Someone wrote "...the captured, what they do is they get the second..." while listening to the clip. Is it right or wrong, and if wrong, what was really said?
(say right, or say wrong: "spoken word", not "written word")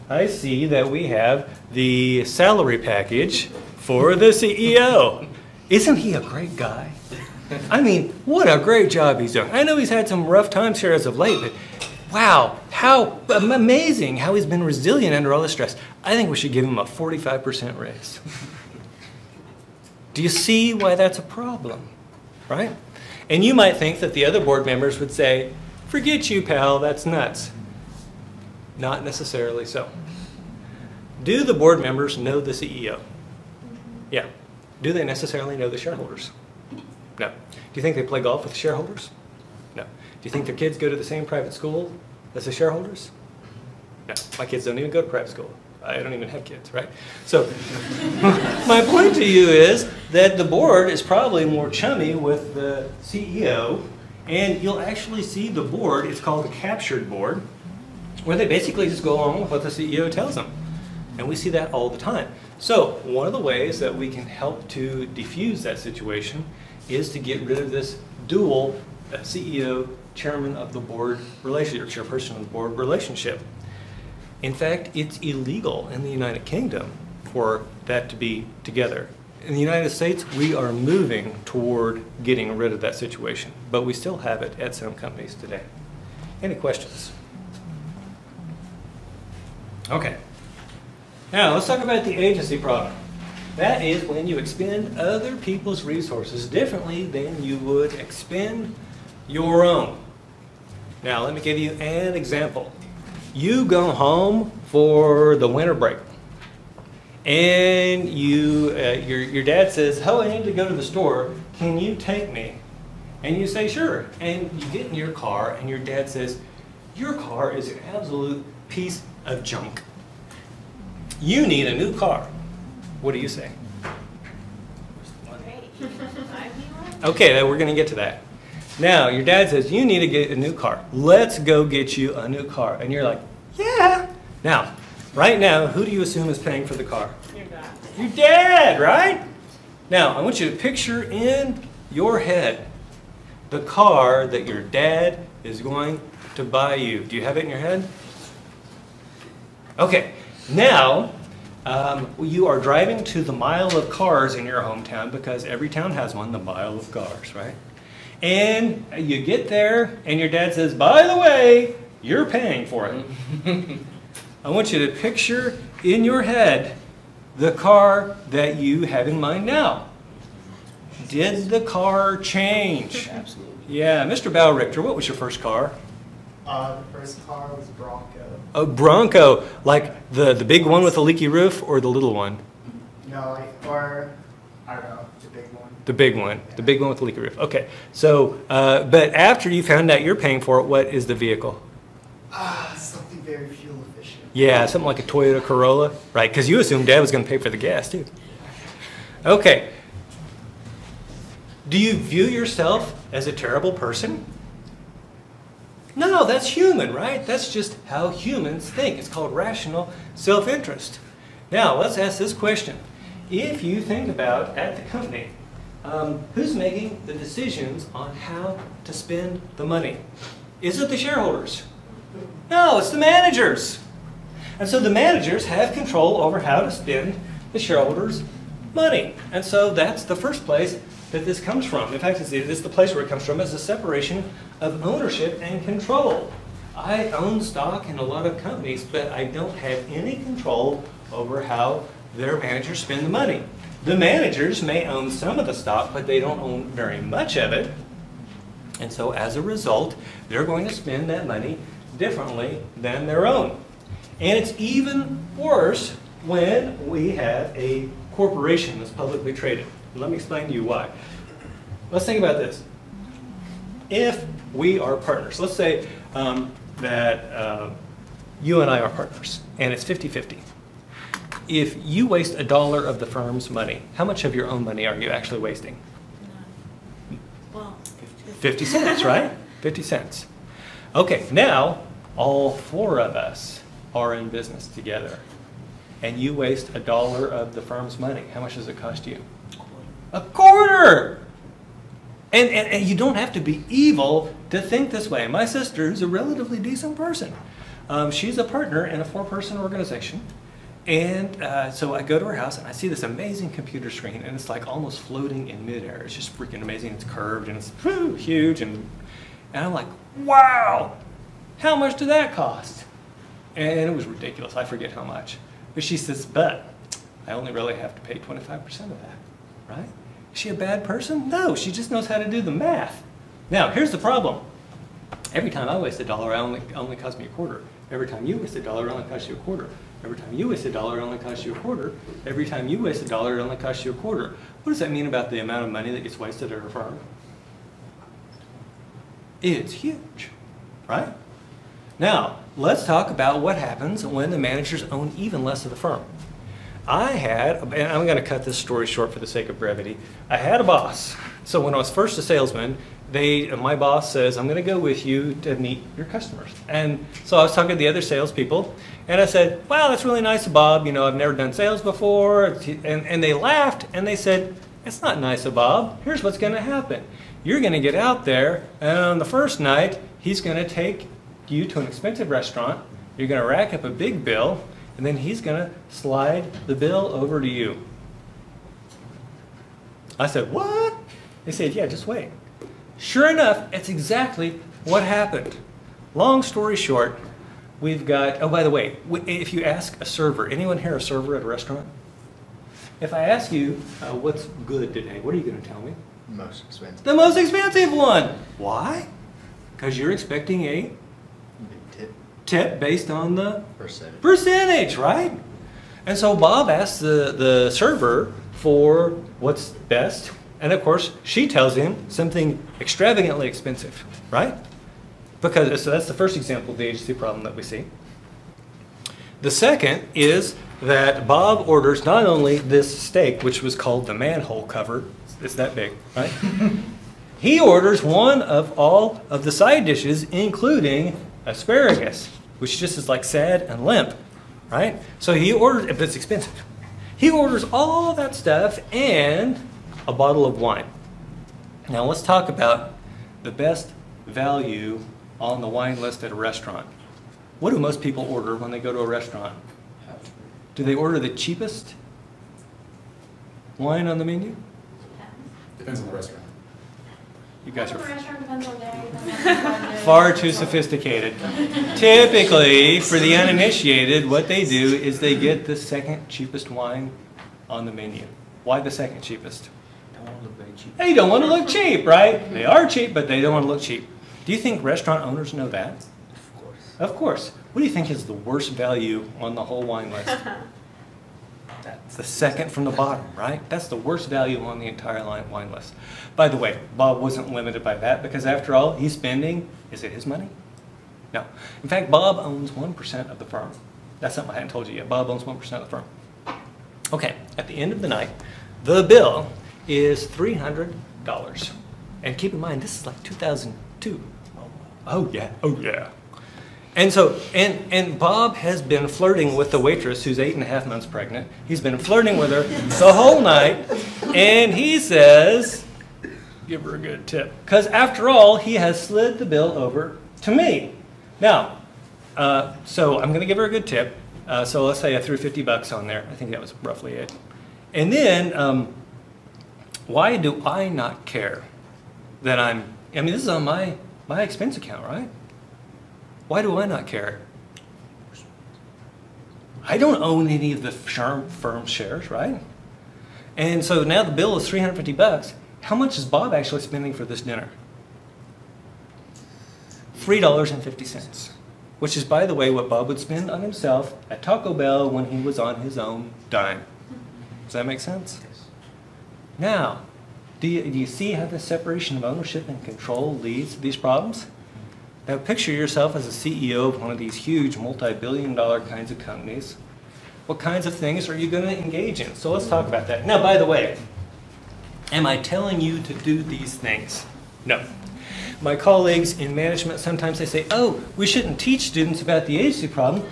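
wrong: "uninitiated", not "captured".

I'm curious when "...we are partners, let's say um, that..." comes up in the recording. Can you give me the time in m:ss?
4:24.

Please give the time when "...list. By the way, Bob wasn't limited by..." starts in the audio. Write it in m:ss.
8:05.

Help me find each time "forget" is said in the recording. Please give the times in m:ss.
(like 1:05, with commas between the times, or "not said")
0:25, 5:14.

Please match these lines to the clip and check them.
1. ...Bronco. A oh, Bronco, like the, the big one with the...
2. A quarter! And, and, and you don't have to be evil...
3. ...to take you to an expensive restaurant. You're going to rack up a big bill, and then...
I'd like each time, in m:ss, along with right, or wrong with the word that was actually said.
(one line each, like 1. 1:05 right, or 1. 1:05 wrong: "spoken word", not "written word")
1. 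2:57 right
2. 4:50 right
3. 6:10 right.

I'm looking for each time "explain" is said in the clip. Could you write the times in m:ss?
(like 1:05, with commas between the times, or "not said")
4:20.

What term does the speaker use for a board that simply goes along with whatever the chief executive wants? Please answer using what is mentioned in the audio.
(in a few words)
captured board.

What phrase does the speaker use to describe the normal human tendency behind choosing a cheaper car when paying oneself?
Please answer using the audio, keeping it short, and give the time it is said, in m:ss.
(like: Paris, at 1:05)
rational self interest, at 3:29.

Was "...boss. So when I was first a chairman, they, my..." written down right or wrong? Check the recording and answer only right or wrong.
wrong.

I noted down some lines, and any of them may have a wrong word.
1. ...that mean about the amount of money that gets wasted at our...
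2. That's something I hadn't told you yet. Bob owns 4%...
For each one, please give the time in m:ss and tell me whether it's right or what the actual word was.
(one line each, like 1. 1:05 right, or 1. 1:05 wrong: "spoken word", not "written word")
1. 5:34 right
2. 8:14 wrong: "1", not "4".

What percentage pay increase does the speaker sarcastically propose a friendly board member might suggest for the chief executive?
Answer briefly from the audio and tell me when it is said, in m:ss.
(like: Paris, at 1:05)
45%, at 0:16.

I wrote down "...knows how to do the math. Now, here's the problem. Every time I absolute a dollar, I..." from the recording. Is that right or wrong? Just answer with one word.
wrong.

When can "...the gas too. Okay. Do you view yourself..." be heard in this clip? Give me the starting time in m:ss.
3:17.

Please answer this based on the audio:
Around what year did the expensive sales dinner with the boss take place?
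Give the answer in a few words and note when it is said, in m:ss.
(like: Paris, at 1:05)
2002, at 8:23.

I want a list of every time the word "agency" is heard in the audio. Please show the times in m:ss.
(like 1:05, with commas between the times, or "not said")
1:32, 6:56, 9:42.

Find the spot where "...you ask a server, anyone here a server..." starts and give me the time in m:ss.
6:29.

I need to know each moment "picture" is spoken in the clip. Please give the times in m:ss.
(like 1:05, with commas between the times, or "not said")
2:20, 2:44, 9:25.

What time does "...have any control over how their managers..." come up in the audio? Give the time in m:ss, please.
3:59.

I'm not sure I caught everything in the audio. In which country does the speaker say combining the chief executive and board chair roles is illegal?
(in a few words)
United Kingdom.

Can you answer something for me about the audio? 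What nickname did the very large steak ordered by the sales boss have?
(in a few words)
manhole cover.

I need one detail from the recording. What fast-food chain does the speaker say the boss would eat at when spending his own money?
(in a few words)
Taco Bell.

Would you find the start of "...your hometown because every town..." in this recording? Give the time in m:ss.
2:34.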